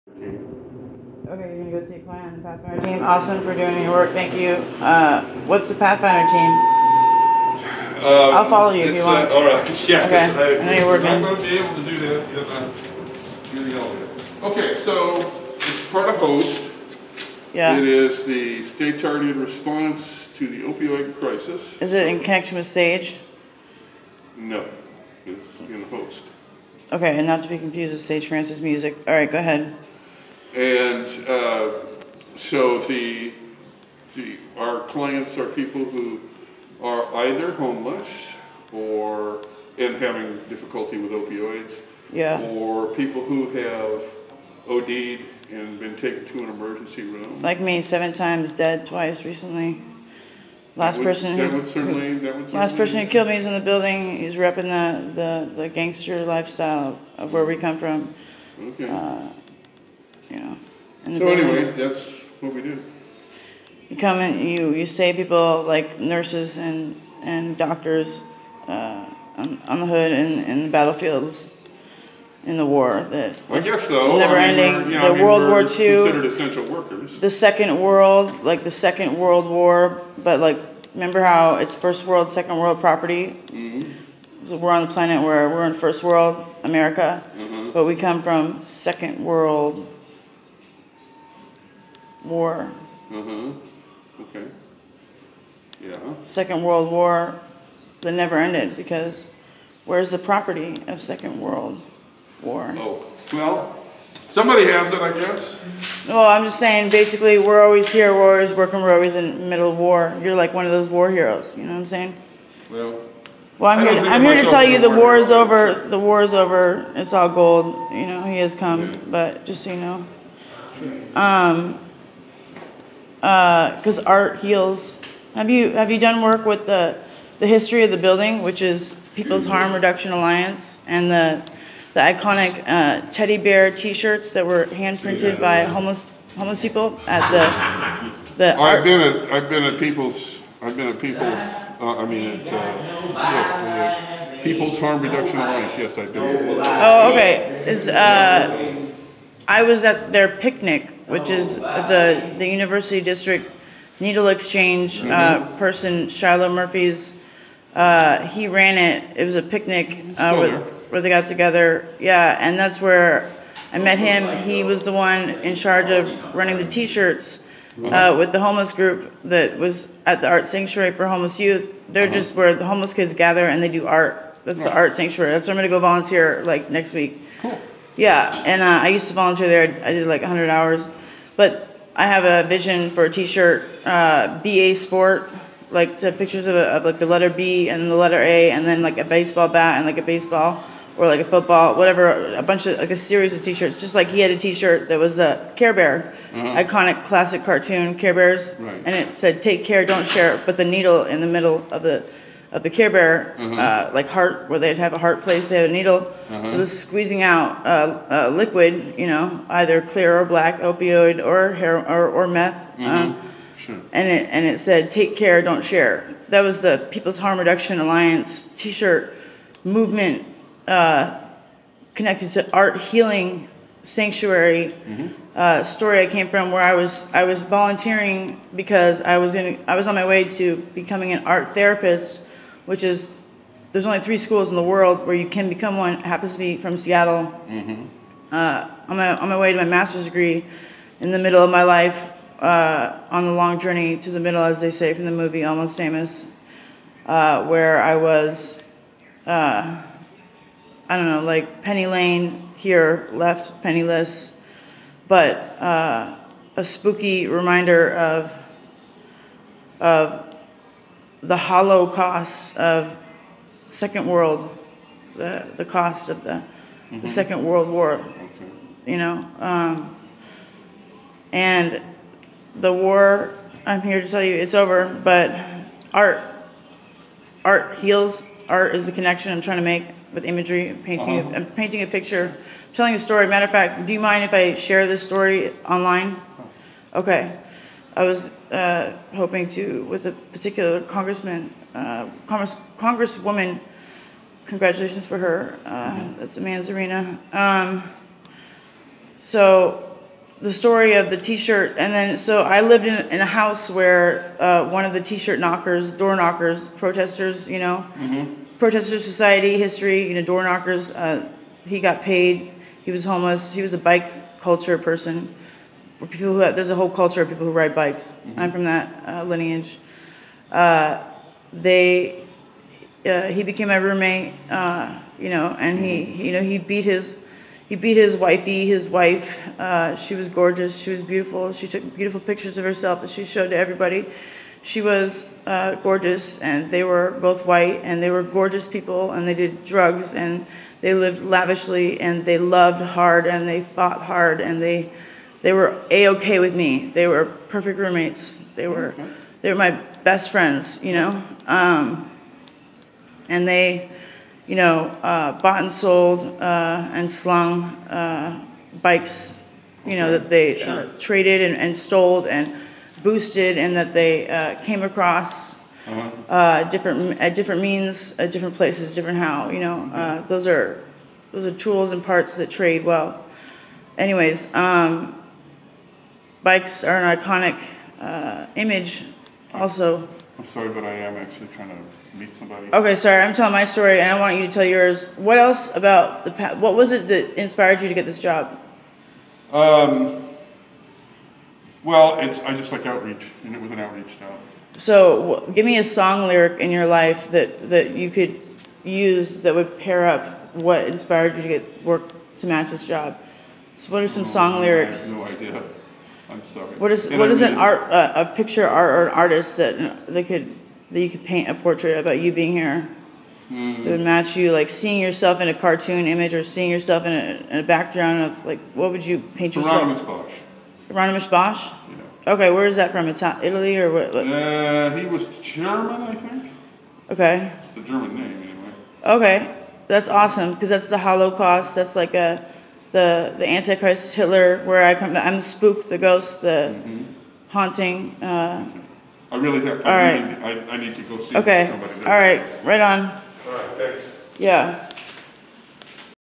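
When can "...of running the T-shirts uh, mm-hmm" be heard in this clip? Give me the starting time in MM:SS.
02:45.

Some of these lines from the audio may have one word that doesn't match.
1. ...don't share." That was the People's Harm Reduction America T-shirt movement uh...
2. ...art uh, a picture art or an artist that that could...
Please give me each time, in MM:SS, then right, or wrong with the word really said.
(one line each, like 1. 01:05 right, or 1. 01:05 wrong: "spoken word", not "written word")
1. 03:35 wrong: "Alliance", not "America"
2. 06:47 right.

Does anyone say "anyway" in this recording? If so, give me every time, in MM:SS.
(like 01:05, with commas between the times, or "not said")
01:01, 06:13, 07:08.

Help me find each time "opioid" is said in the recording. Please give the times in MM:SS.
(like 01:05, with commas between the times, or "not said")
00:20, 00:41, 03:30.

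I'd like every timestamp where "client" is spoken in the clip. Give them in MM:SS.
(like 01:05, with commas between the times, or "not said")
00:01, 00:34.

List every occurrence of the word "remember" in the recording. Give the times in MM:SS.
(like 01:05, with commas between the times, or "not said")
01:20.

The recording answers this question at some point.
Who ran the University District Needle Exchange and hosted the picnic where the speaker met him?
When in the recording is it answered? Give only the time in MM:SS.
02:36.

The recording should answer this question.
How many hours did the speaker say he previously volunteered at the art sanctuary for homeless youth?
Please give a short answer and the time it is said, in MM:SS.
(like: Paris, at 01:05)
100, at 03:00.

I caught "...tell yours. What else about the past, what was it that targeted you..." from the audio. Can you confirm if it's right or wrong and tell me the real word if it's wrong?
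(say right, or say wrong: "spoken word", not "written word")
wrong: "inspired", not "targeted".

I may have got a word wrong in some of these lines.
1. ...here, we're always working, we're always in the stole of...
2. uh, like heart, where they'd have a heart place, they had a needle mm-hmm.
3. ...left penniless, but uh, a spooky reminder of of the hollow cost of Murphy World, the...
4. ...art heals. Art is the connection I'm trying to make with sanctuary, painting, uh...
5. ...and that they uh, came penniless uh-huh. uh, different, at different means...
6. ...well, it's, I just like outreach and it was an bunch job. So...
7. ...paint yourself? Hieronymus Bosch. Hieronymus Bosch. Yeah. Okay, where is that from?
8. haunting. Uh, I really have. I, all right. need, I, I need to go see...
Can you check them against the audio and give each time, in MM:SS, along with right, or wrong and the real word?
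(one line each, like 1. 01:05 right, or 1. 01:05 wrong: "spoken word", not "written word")
1. 01:47 wrong: "middle", not "stole"
2. 03:23 right
3. 04:13 wrong: "Second", not "Murphy"
4. 04:37 wrong: "imagery", not "sanctuary"
5. 06:03 wrong: "across", not "penniless"
6. 06:31 wrong: "outreach", not "bunch"
7. 06:59 right
8. 07:17 right.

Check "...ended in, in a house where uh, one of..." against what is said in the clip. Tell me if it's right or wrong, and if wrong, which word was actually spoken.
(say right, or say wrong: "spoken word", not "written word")
wrong: "lived", not "ended".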